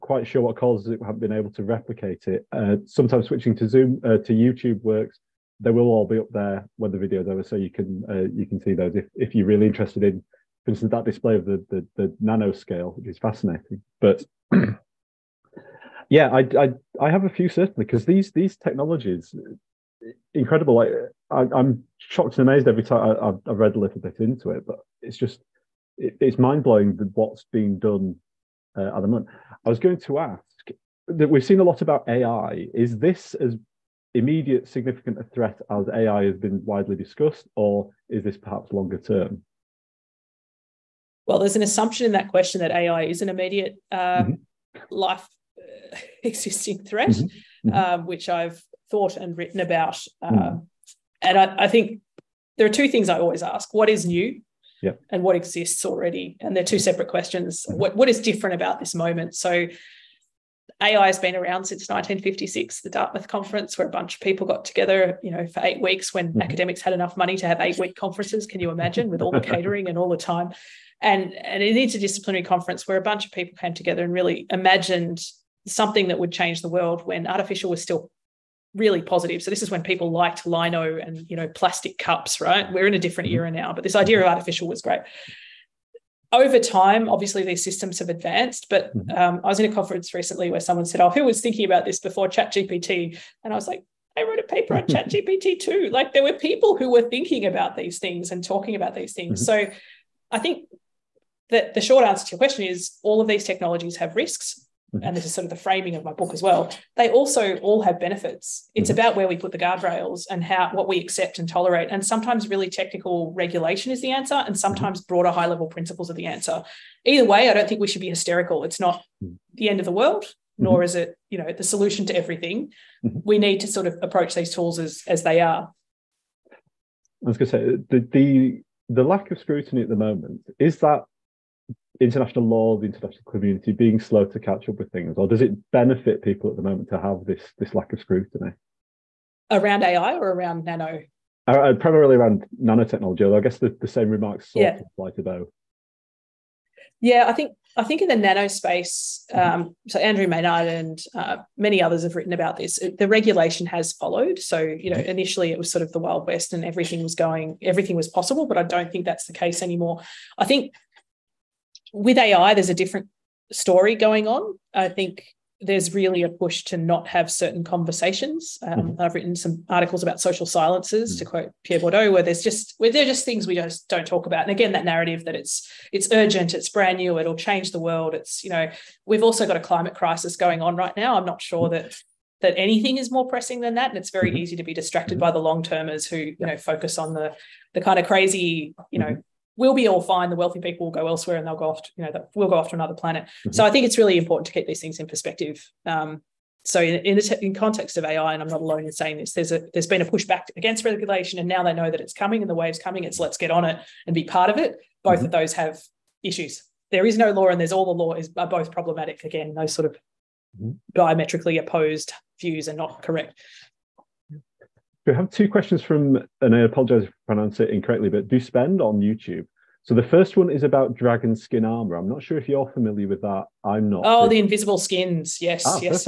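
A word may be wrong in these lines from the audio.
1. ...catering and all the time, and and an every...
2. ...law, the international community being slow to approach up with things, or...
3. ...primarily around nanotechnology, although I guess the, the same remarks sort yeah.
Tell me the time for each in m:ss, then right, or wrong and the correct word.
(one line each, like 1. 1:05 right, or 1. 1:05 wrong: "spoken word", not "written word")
1. 1:09 wrong: "interdisciplinary", not "every"
2. 2:12 wrong: "catch", not "approach"
3. 2:21 right.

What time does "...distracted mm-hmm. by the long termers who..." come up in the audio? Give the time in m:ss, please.
3:04.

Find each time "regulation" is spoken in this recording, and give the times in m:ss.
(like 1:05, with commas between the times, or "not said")
1:53, 2:33, 3:20.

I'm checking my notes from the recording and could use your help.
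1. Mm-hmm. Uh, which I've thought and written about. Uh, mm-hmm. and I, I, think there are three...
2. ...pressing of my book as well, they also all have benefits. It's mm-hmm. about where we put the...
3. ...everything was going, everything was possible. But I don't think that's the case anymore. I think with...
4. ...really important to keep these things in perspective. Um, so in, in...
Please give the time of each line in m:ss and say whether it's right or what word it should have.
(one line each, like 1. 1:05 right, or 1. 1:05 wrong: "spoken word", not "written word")
1. 0:47 wrong: "two", not "three"
2. 1:45 wrong: "framing", not "pressing"
3. 2:36 right
4. 3:13 right.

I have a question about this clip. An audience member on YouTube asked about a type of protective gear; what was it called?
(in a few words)
dragon skin armor.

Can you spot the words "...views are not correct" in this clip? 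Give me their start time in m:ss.
3:32.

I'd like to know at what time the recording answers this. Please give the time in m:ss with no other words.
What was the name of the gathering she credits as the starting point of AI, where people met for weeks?
1:02.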